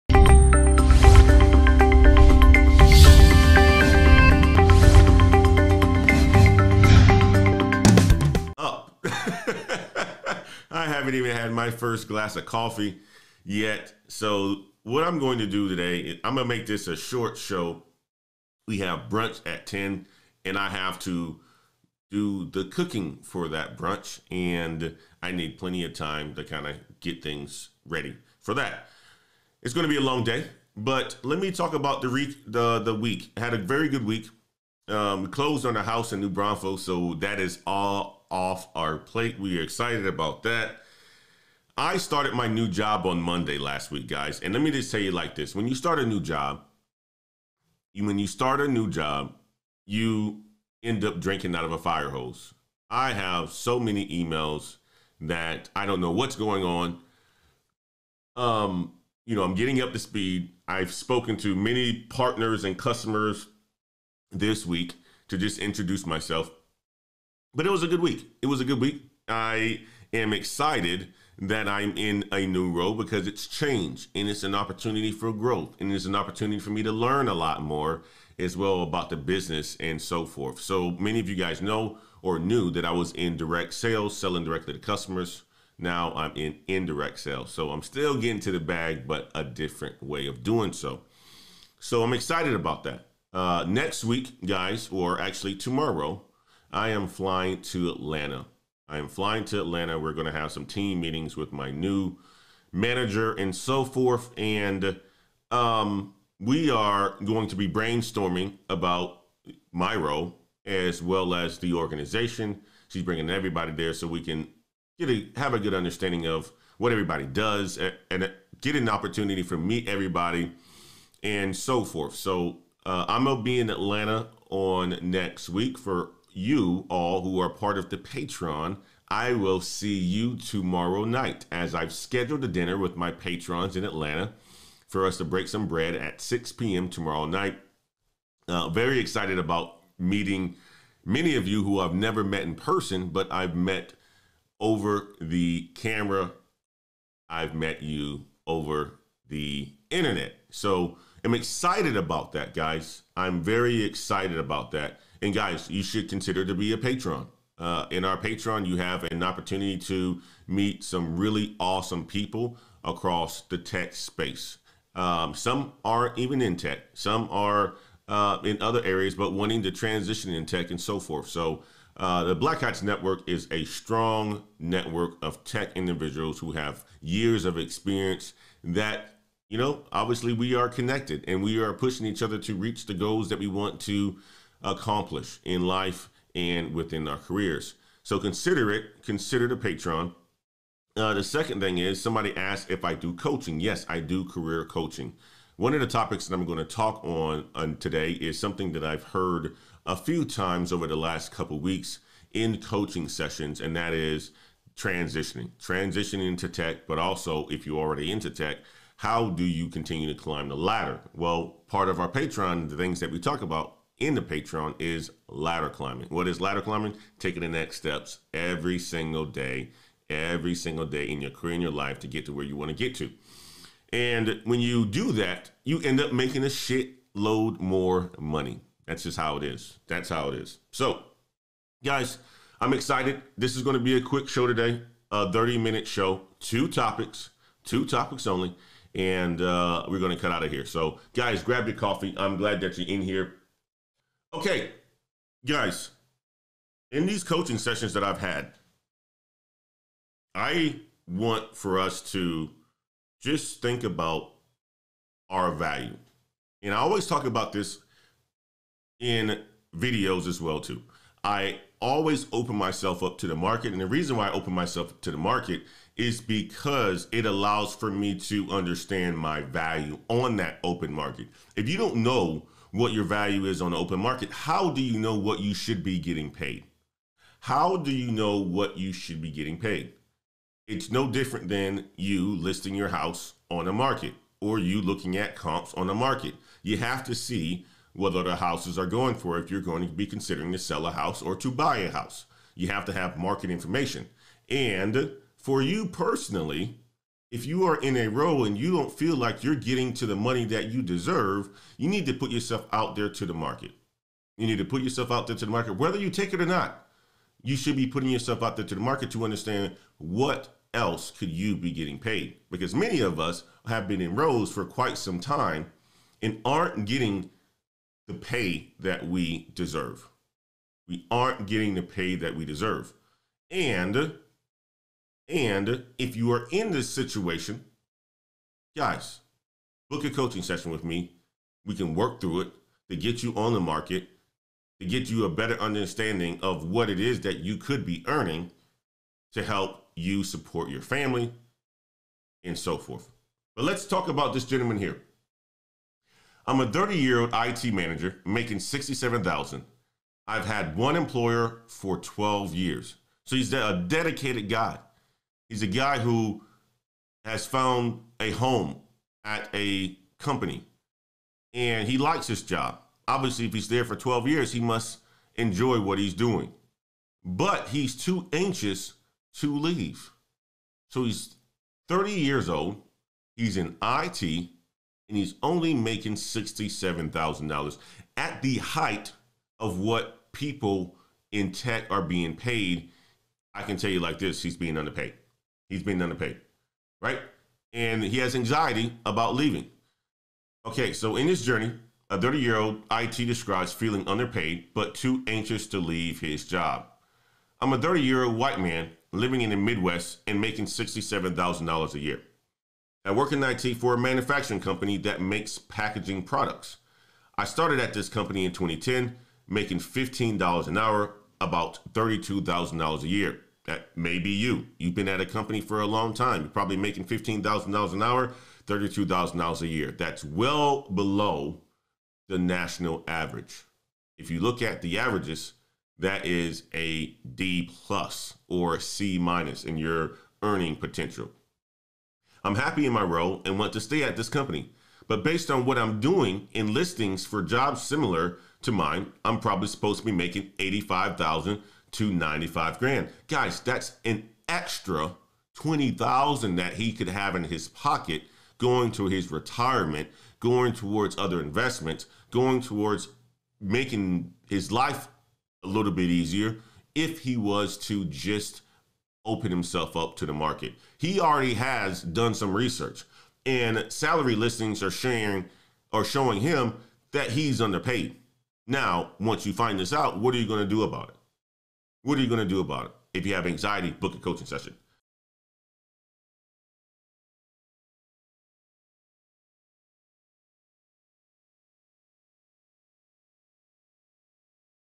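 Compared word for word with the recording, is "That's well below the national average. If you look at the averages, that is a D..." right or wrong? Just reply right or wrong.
right.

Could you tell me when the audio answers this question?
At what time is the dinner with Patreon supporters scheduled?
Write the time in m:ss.
2:16.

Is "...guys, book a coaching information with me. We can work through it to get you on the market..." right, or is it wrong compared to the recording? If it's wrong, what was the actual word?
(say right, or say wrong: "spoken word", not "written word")
wrong: "session", not "information".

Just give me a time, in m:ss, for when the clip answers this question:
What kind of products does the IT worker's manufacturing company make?
6:45.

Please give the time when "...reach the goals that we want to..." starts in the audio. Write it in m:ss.
3:02.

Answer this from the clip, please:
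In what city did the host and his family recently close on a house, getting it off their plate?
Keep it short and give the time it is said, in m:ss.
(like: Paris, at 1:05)
New Braunfels, at 0:36.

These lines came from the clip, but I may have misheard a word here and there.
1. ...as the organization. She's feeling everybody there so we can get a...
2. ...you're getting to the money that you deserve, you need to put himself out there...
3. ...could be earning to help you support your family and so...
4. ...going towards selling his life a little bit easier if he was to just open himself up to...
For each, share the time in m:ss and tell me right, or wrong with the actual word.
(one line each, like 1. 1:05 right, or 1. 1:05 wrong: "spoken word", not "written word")
1. 1:51 wrong: "bringing", not "feeling"
2. 4:59 wrong: "yourself", not "himself"
3. 5:37 right
4. 7:32 wrong: "making", not "selling".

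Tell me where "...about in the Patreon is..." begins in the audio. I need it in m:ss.
3:33.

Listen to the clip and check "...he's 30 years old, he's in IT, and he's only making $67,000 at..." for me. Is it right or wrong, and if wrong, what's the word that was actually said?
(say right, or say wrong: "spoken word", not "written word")
right.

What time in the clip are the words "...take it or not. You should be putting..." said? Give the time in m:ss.
5:06.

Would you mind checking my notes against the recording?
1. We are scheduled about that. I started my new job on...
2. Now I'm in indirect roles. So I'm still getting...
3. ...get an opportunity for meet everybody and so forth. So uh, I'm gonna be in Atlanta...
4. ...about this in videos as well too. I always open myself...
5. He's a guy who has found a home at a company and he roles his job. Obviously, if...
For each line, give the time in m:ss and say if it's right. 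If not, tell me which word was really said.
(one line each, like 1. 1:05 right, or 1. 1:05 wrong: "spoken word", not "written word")
1. 0:39 wrong: "excited", not "scheduled"
2. 1:25 wrong: "sales", not "roles"
3. 1:58 right
4. 4:17 right
5. 5:55 wrong: "likes", not "roles".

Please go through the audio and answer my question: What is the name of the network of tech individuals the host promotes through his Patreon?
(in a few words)
Black Heights Network.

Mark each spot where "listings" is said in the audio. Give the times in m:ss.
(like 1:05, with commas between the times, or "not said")
4:42, 7:16, 7:44.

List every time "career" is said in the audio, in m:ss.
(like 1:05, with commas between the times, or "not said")
3:07, 3:14, 3:41.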